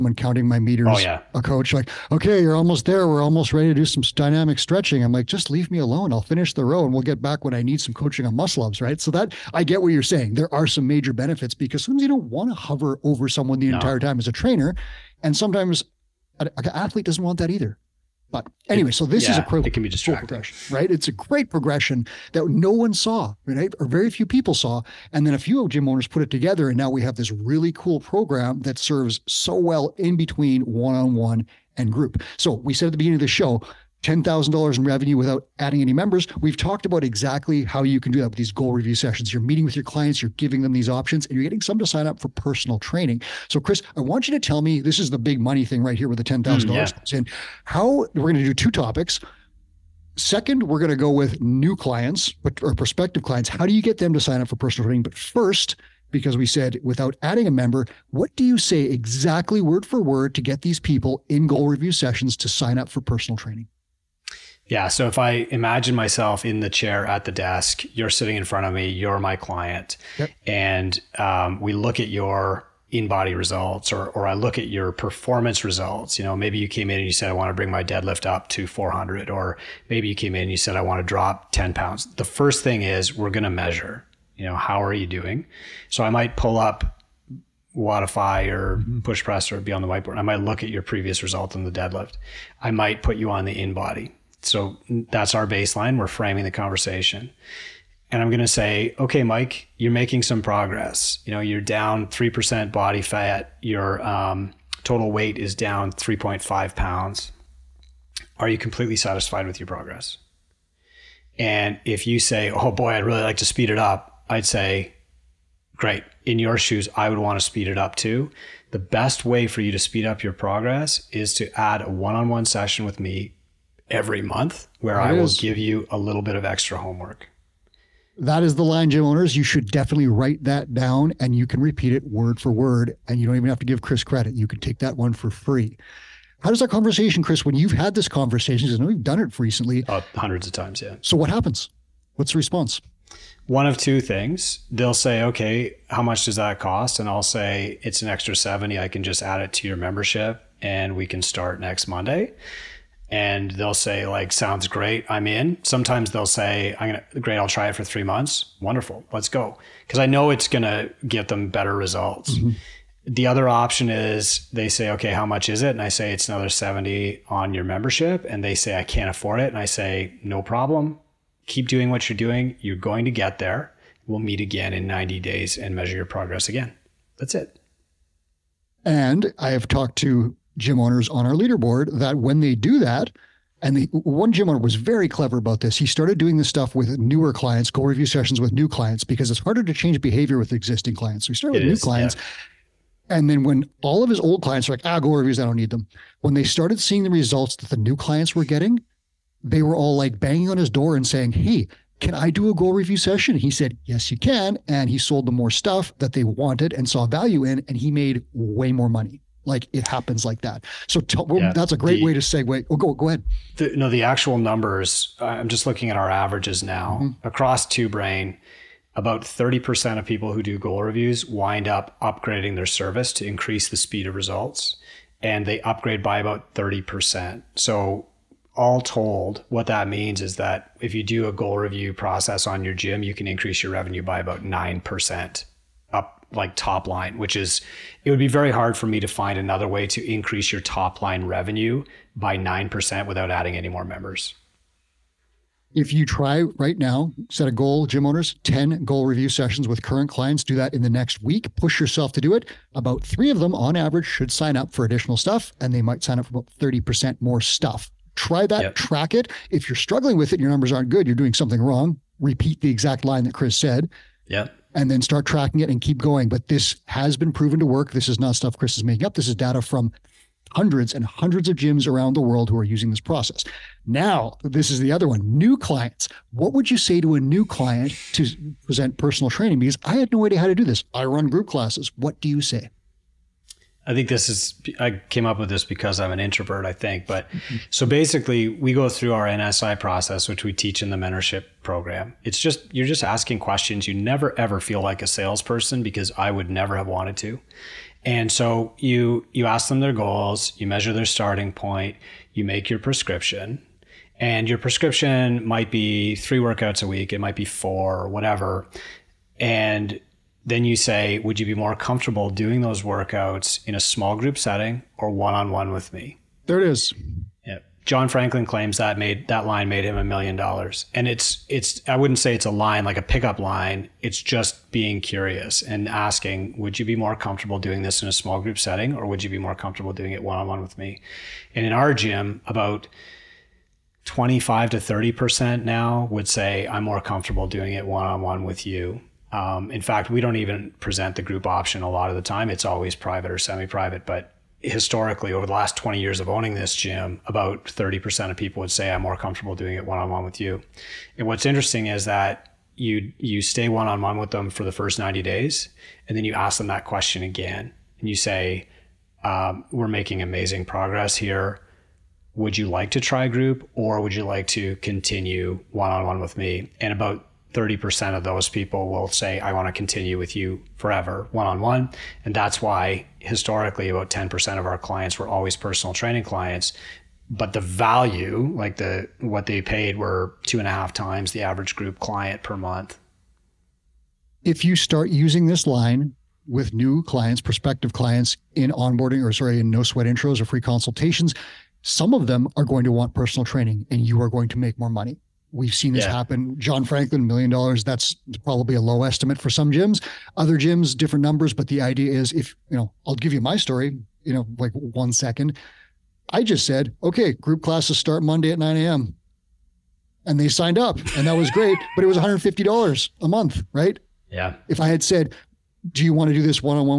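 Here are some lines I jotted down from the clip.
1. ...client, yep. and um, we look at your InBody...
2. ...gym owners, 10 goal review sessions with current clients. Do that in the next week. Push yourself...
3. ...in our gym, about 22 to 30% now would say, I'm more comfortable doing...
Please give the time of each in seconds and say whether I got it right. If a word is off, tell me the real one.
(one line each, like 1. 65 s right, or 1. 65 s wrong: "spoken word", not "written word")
1. 69 s right
2. 247 s right
3. 331 s wrong: "25", not "22".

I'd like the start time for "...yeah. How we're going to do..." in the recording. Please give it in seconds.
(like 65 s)
47 s.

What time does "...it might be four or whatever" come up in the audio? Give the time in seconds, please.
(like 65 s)
307 s.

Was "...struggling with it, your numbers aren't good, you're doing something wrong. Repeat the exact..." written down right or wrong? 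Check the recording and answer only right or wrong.
right.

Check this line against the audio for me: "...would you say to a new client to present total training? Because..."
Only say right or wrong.
wrong.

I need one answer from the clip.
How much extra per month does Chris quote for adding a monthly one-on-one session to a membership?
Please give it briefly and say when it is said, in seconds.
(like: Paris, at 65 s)
70, at 148 s.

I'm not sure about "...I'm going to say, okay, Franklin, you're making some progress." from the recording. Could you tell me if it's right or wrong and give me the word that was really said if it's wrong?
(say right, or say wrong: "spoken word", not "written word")
wrong: "Mike", not "Franklin".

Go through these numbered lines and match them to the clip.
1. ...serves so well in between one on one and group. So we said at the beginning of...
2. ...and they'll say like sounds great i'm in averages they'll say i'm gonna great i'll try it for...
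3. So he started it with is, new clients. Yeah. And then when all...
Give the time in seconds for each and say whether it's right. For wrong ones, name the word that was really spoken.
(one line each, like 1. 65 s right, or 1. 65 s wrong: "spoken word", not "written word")
1. 28 s right
2. 153 s wrong: "sometimes", not "averages"
3. 191 s right.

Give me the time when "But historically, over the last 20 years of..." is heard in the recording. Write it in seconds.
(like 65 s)
344 s.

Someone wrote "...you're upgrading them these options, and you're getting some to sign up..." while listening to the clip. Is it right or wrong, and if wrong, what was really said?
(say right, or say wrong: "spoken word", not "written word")
wrong: "giving", not "upgrading".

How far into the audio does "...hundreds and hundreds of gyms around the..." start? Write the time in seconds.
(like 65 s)
270 s.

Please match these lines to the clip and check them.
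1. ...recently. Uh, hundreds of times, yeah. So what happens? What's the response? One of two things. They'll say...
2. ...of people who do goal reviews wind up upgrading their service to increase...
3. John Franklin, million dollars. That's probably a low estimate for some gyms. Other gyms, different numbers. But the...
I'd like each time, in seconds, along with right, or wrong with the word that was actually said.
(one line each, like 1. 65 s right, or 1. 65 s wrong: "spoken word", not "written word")
1. 139 s right
2. 219 s right
3. 396 s right.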